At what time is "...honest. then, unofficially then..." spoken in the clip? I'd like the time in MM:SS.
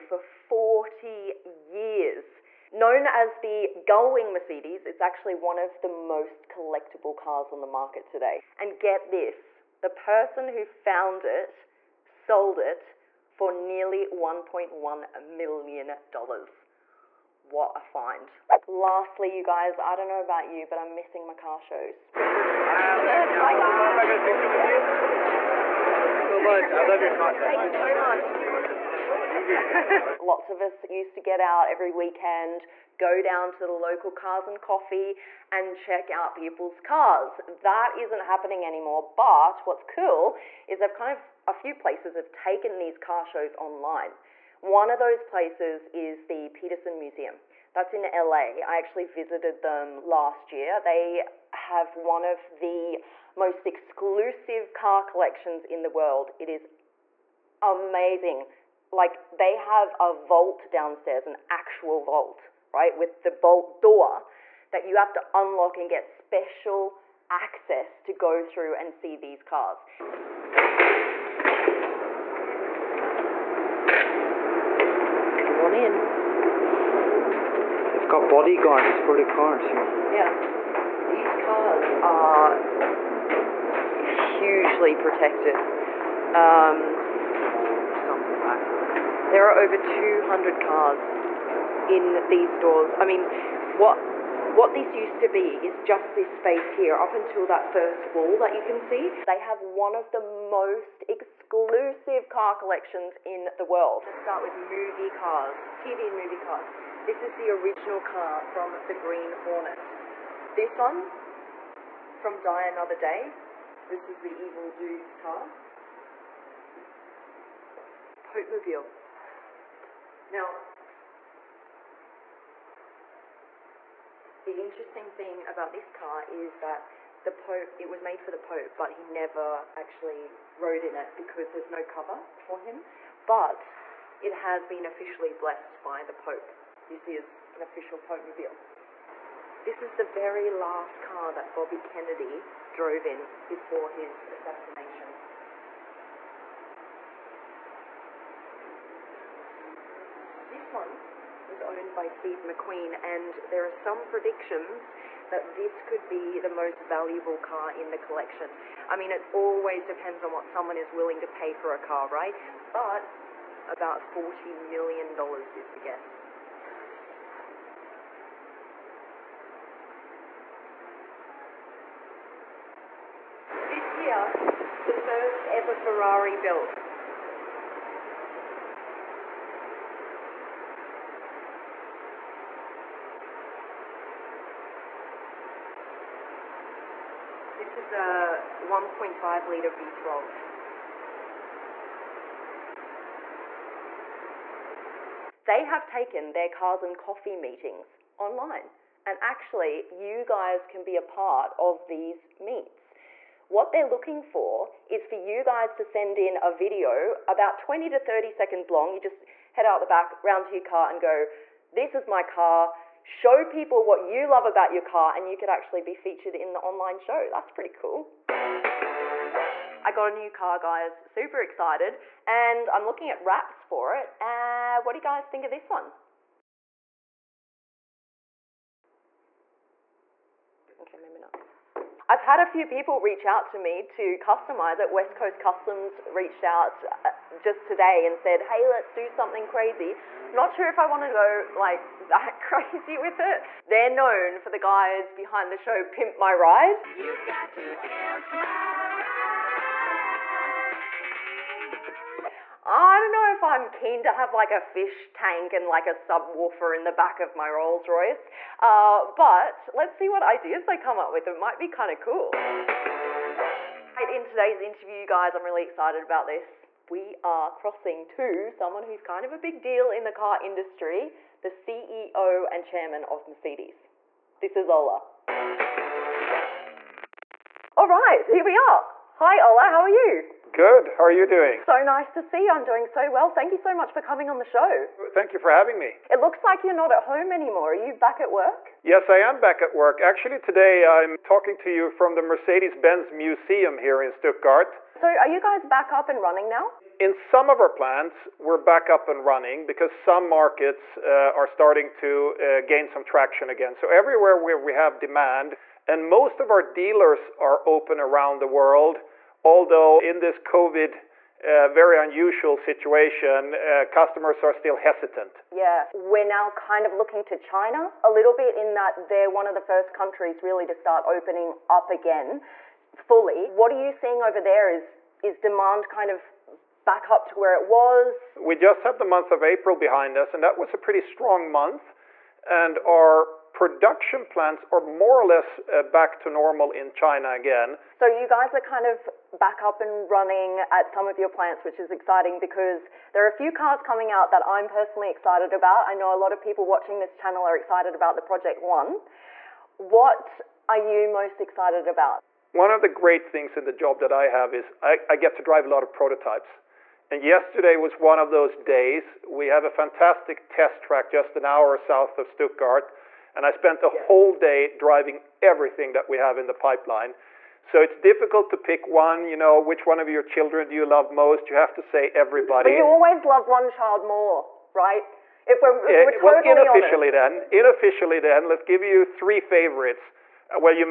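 06:17.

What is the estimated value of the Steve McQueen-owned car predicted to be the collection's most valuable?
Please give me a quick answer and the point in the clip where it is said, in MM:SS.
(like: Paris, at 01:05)
$40 million, at 02:43.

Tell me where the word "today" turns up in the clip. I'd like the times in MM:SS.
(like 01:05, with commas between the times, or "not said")
00:08, 03:57, 04:24, 04:50.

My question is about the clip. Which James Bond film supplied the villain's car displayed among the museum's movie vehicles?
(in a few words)
Die Another Day.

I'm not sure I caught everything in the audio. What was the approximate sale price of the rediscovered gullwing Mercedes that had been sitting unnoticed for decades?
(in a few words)
$1.1 million.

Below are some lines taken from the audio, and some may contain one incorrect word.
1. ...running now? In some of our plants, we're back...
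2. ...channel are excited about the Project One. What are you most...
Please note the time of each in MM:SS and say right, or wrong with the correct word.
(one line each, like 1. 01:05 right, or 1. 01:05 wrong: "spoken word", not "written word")
1. 04:56 right
2. 05:47 right.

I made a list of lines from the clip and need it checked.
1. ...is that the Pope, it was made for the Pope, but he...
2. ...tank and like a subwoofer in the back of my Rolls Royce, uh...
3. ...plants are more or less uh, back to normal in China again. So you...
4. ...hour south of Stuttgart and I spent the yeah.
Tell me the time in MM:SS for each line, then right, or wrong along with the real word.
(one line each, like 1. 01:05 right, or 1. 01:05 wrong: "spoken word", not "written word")
1. 02:06 right
2. 04:15 right
3. 05:34 right
4. 06:01 right.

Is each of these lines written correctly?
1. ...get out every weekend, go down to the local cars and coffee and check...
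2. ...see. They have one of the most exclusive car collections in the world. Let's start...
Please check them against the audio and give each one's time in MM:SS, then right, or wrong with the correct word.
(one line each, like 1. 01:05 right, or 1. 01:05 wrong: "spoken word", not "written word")
1. 00:31 right
2. 01:38 right.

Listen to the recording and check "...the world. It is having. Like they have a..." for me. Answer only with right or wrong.
wrong.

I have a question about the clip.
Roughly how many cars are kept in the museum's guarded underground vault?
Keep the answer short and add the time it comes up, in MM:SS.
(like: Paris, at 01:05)
over 200, at 01:29.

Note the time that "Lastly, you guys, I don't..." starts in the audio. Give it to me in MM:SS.
00:18.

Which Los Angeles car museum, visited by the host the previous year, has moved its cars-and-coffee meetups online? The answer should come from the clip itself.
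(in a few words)
Petersen Museum.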